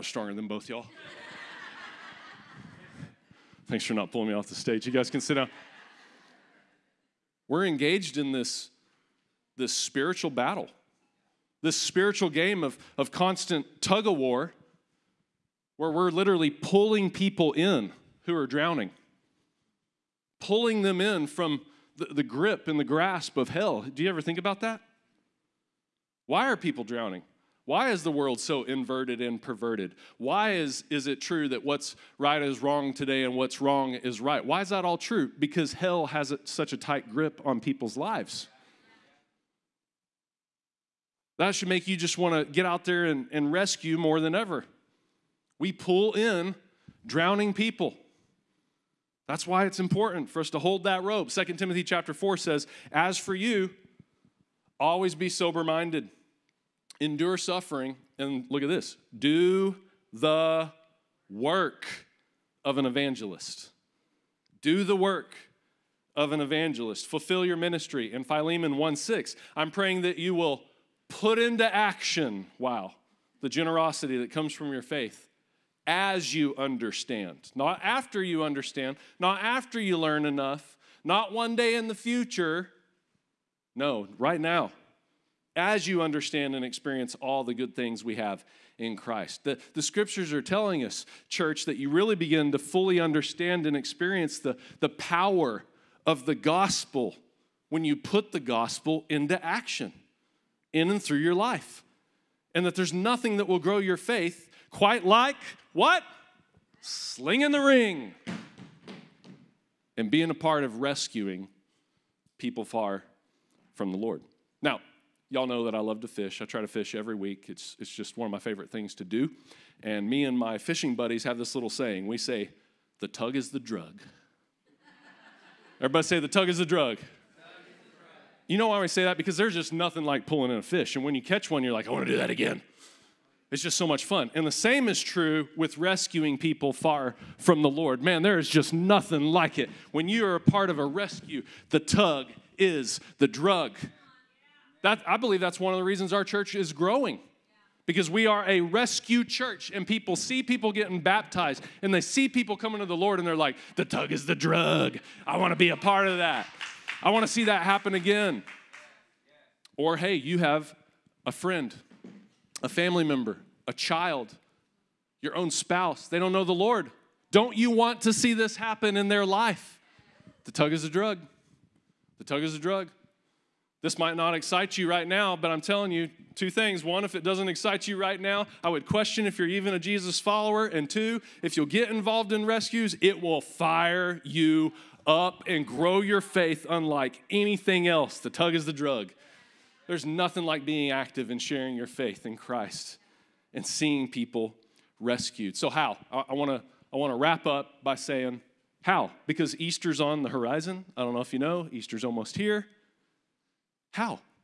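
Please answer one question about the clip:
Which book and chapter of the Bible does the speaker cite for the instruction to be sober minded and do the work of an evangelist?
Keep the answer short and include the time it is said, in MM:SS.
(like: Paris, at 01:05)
2 Timothy chapter 4, at 00:51.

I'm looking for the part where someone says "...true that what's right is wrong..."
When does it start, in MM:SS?
00:31.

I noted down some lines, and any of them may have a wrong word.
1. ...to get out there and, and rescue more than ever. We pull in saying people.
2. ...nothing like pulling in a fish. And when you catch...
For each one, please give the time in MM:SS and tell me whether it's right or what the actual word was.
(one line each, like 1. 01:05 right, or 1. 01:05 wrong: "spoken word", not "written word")
1. 00:42 wrong: "drowning", not "saying"
2. 02:09 right.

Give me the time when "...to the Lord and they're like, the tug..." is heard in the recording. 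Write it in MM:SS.
02:32.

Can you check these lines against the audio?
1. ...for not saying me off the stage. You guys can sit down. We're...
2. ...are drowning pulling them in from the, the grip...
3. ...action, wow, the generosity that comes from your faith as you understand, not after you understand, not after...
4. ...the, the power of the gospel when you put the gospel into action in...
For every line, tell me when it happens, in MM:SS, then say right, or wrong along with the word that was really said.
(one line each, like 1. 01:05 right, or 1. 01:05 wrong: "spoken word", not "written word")
1. 00:03 wrong: "pulling", not "saying"
2. 00:18 right
3. 01:11 right
4. 01:34 right.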